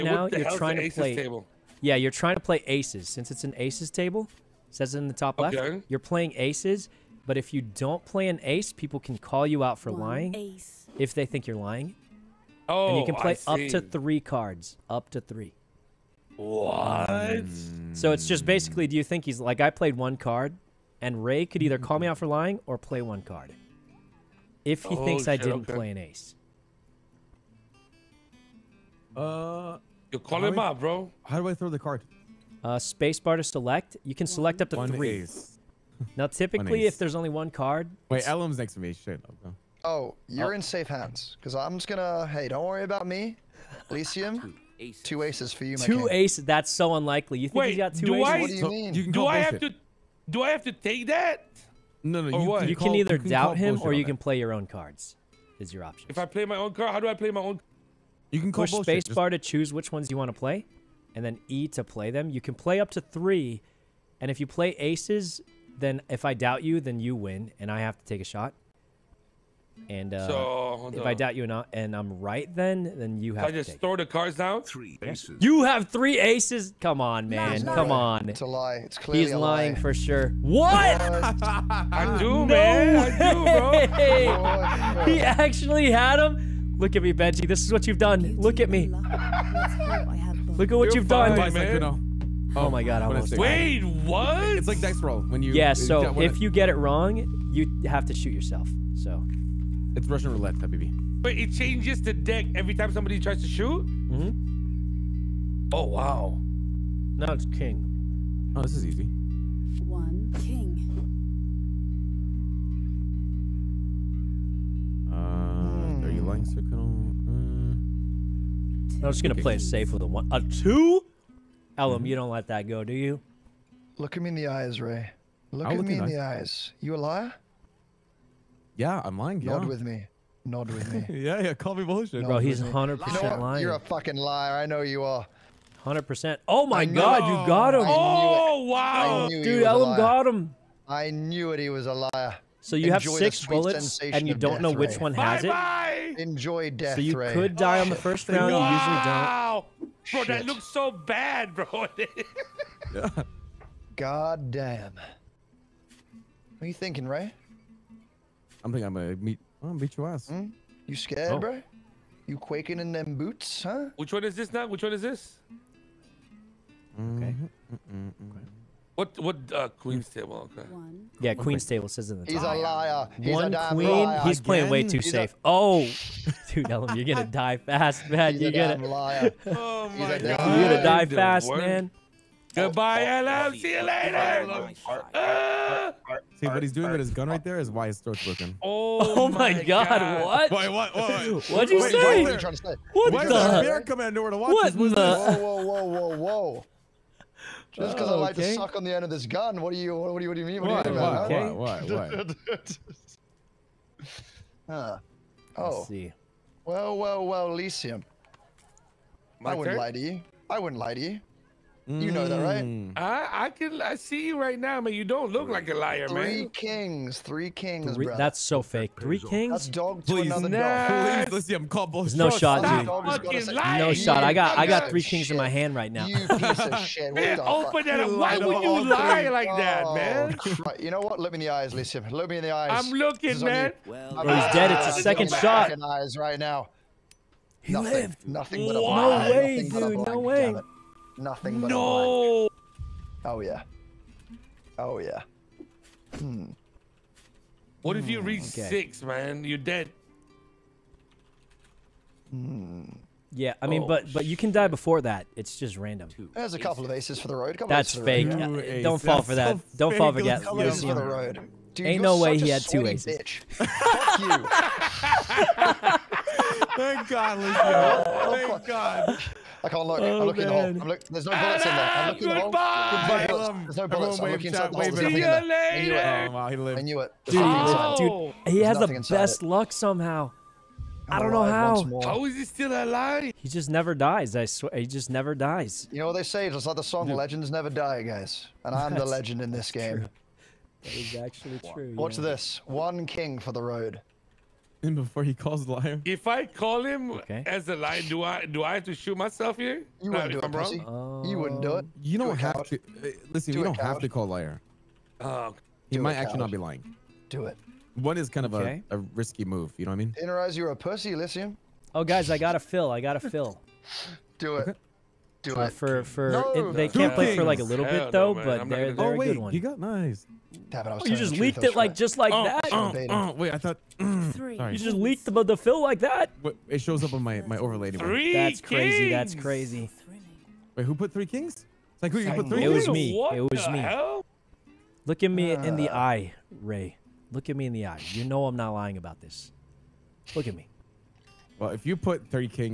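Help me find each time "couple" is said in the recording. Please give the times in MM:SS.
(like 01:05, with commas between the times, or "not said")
04:16.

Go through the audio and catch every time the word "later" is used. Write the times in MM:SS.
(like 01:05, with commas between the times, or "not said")
03:03, 04:35.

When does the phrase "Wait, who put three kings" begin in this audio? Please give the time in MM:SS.
05:30.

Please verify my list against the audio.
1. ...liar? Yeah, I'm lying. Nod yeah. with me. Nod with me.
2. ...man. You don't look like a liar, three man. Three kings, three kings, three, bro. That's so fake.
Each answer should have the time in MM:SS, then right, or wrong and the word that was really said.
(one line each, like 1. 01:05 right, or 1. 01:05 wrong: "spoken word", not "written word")
1. 02:07 right
2. 03:34 right.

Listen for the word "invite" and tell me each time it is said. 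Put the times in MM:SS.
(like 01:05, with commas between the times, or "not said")
not said.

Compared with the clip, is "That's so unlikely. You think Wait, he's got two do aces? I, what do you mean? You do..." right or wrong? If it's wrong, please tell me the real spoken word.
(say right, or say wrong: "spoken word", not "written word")
right.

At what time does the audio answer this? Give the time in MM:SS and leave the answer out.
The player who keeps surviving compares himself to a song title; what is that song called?
04:47.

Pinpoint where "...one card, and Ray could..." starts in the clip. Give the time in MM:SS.
00:19.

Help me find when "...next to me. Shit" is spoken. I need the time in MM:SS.
00:38.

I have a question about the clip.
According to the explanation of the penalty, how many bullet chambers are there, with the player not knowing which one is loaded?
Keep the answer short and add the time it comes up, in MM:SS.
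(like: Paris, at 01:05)
6, at 02:23.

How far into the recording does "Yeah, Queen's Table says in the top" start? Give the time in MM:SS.
02:51.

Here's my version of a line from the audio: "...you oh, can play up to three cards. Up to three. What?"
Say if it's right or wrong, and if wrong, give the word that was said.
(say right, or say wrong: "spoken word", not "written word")
right.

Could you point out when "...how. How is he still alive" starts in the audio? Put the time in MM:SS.
04:41.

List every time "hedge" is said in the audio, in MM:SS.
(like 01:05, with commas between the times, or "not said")
not said.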